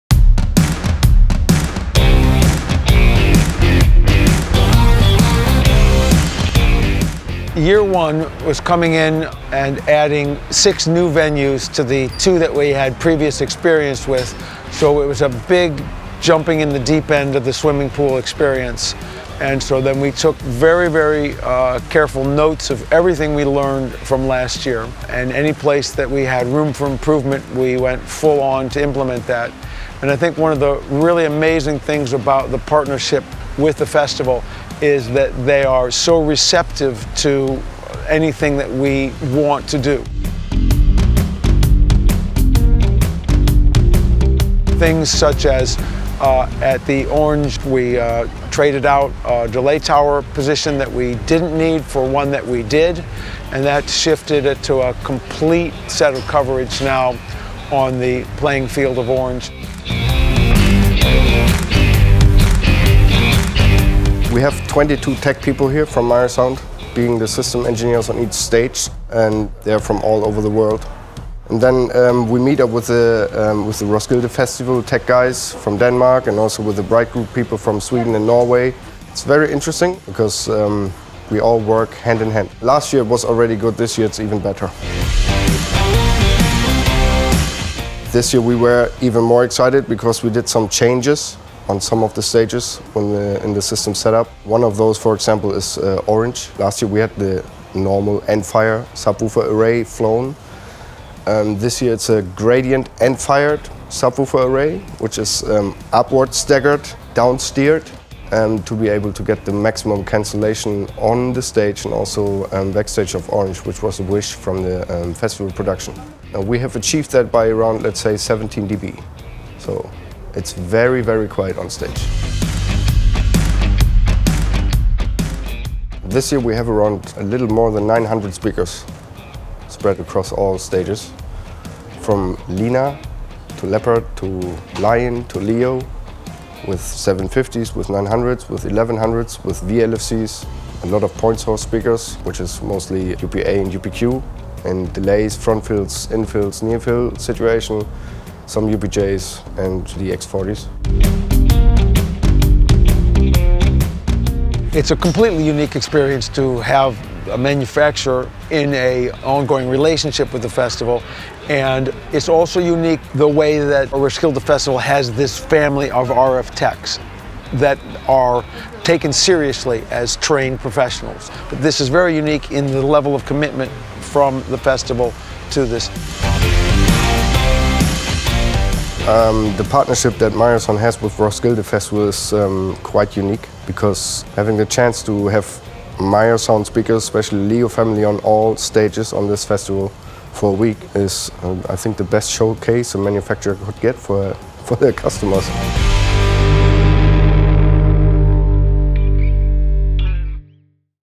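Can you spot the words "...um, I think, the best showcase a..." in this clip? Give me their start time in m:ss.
3:11.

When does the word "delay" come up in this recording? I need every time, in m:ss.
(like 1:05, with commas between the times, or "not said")
0:49, 2:24.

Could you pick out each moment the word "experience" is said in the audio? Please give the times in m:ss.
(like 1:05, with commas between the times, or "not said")
0:13, 0:18, 2:35.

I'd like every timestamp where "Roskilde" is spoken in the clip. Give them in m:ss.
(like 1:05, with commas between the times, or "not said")
1:13, 2:43, 3:01.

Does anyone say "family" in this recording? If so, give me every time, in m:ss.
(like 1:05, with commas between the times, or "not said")
2:45, 3:07.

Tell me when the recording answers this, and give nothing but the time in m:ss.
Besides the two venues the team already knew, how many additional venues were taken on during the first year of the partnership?
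0:10.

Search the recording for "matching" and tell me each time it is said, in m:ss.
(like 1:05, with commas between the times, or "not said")
not said.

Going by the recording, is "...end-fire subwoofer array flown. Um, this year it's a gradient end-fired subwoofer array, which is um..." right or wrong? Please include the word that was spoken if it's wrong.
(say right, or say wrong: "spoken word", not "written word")
right.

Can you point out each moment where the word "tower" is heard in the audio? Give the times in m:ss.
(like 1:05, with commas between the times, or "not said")
0:49.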